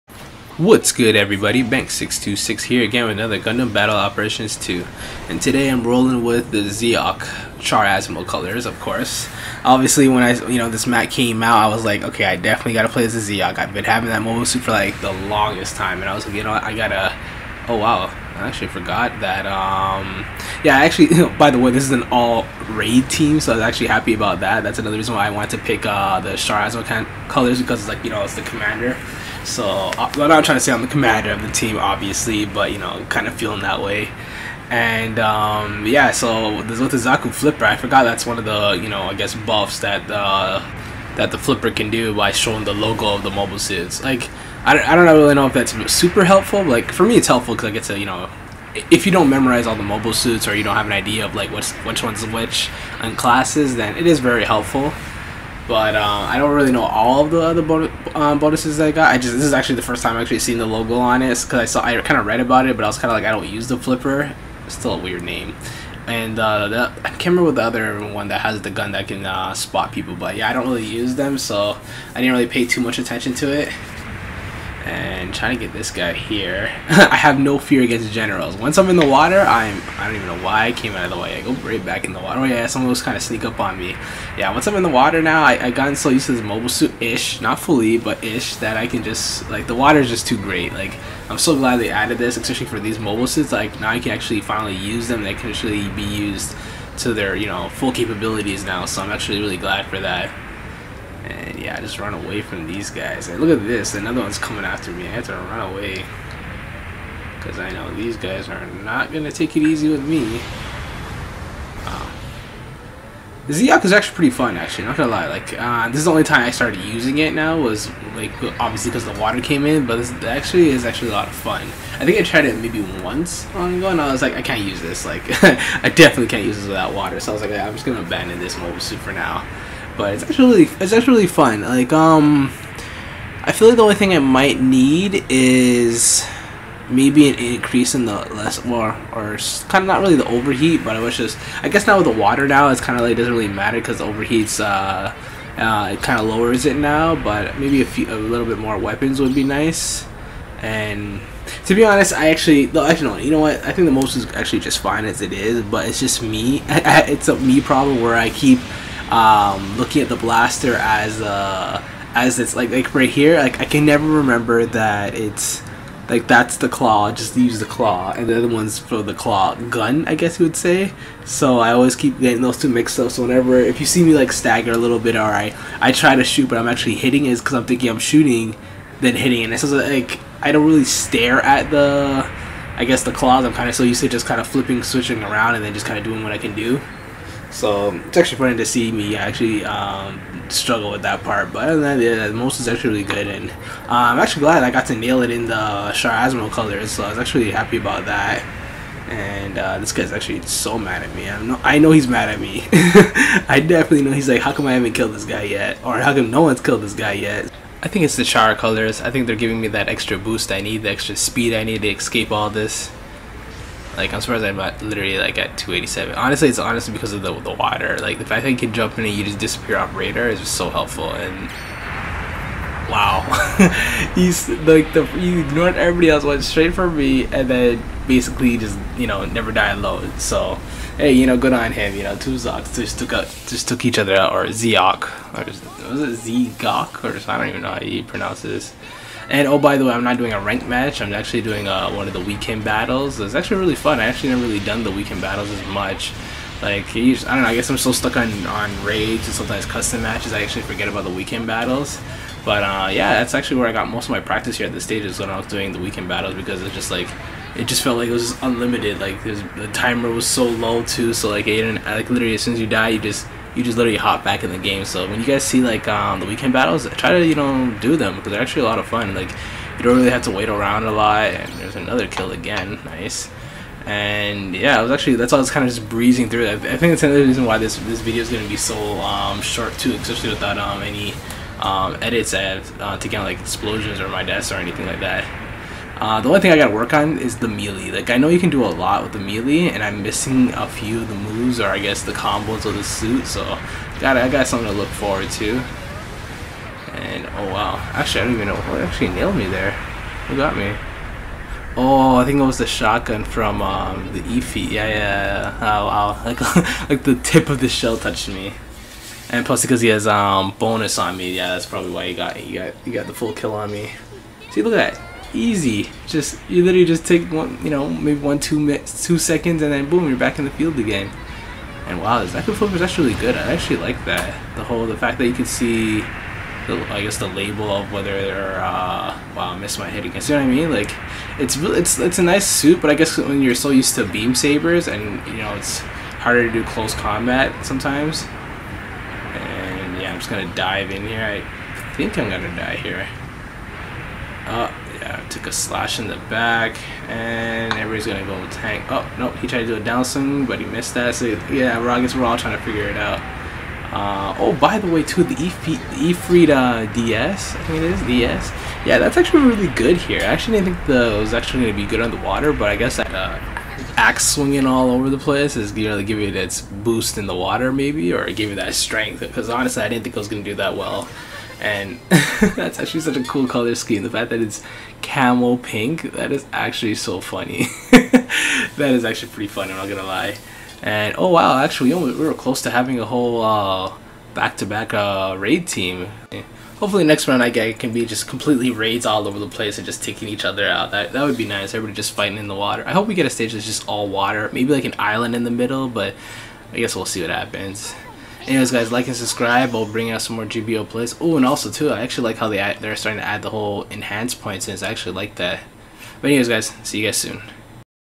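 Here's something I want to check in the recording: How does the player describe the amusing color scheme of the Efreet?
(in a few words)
camel pink.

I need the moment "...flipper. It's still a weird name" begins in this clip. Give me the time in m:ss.
1:03.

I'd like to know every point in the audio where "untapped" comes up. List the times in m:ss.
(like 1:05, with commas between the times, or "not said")
not said.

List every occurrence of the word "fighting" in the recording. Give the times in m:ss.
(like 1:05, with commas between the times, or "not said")
6:32.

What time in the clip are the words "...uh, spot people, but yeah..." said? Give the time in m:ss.
1:09.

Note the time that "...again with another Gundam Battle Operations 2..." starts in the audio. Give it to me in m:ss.
0:02.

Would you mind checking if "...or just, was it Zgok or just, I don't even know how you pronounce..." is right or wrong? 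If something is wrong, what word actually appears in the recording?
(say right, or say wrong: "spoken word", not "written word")
right.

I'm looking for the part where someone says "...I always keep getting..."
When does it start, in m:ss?
2:51.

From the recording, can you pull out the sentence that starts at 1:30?
Like I'm so glad they added this, especially for these mobile suits.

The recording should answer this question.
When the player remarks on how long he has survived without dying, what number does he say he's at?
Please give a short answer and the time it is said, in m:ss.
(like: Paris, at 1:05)
287, at 3:35.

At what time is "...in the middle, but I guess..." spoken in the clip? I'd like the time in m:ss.
6:35.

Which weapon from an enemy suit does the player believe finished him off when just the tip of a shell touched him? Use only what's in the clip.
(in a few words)
shotgun.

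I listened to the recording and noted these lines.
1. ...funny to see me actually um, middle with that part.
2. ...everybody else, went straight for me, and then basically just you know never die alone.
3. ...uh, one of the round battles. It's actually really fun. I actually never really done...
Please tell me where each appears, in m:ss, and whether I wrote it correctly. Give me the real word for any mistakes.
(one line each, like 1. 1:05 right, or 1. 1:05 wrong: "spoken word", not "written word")
1. 3:08 wrong: "struggle", not "middle"
2. 3:45 right
3. 4:01 wrong: "weekend", not "round".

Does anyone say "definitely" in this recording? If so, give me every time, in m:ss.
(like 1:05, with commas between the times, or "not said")
0:12, 2:05, 3:23.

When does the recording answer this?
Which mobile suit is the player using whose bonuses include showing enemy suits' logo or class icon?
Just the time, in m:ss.
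0:36.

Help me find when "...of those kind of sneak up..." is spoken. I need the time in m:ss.
1:22.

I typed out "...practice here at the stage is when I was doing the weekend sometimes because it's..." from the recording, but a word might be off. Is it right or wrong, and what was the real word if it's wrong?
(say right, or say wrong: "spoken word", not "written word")
wrong: "battles", not "sometimes".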